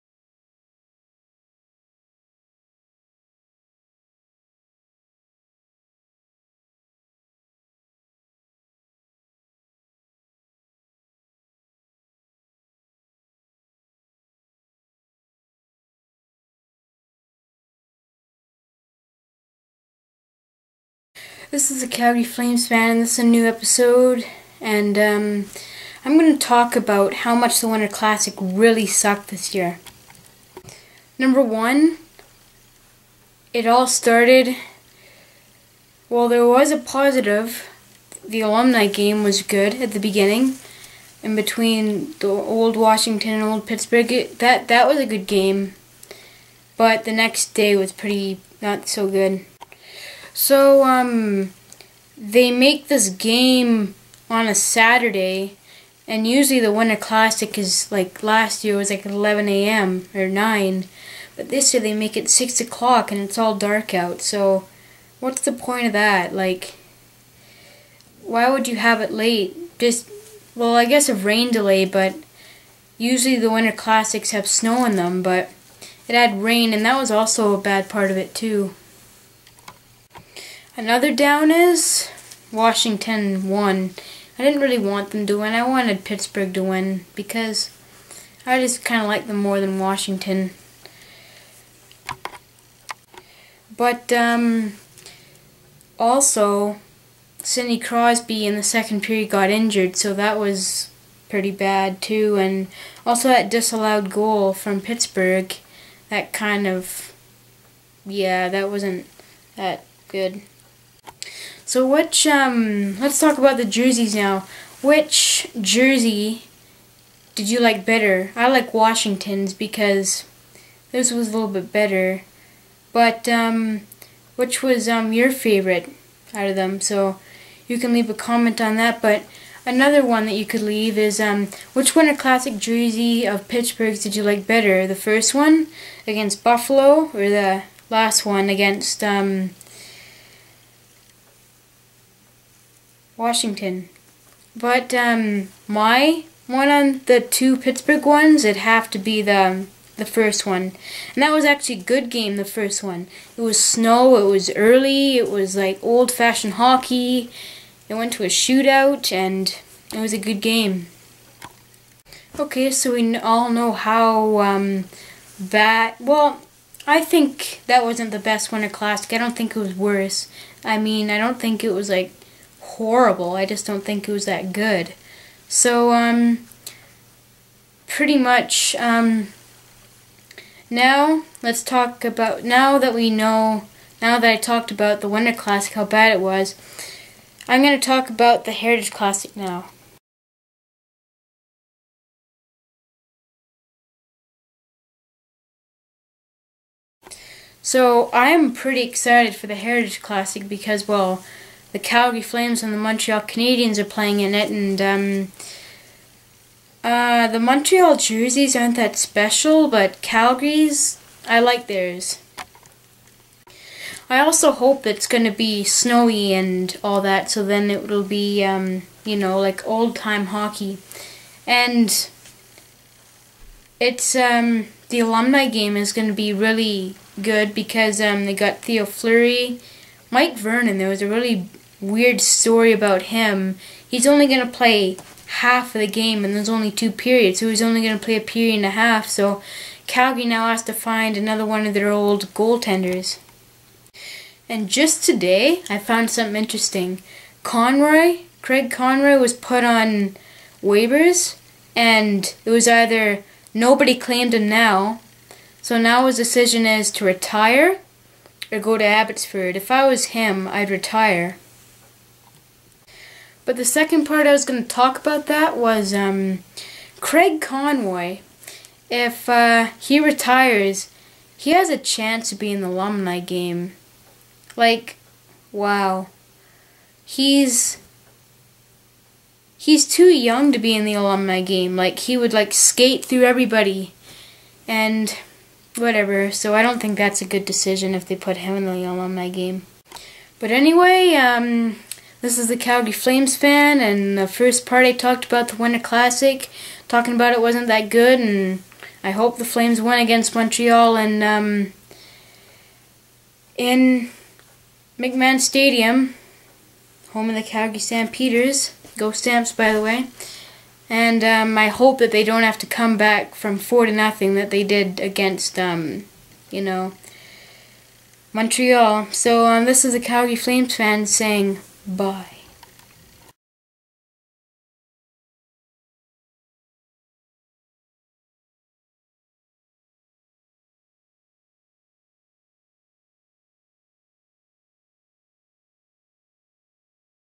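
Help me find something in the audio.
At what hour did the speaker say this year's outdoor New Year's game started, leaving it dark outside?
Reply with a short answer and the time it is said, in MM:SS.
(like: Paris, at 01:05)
6 o'clock, at 01:02.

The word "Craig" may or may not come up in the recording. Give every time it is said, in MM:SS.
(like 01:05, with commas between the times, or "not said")
04:08, 04:26.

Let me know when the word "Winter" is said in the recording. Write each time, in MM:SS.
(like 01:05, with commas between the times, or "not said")
00:27, 00:56, 01:13, 02:11, 02:48, 03:05, 04:55.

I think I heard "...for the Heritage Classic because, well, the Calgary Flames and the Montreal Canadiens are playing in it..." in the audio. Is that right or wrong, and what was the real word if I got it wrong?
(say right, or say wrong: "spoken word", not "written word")
right.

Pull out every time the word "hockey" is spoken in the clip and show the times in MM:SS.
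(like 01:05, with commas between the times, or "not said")
02:36, 03:40.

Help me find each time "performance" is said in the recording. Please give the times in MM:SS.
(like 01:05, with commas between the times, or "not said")
not said.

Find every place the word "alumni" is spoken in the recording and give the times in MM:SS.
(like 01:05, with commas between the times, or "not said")
00:38, 03:44, 04:32, 04:40, 04:48.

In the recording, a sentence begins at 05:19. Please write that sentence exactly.
So um, this is a Calgary Flames fan saying.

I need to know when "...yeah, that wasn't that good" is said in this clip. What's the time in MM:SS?
01:48.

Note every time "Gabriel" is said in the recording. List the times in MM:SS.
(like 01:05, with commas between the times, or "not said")
not said.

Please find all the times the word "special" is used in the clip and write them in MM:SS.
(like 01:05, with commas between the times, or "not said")
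03:28.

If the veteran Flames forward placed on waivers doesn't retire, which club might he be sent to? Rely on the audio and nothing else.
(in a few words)
Abbotsford.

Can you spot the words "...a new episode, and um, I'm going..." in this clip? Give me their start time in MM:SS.
00:23.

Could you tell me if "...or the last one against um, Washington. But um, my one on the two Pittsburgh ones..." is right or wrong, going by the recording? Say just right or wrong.
right.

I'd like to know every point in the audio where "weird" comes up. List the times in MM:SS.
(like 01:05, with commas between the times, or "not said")
03:51.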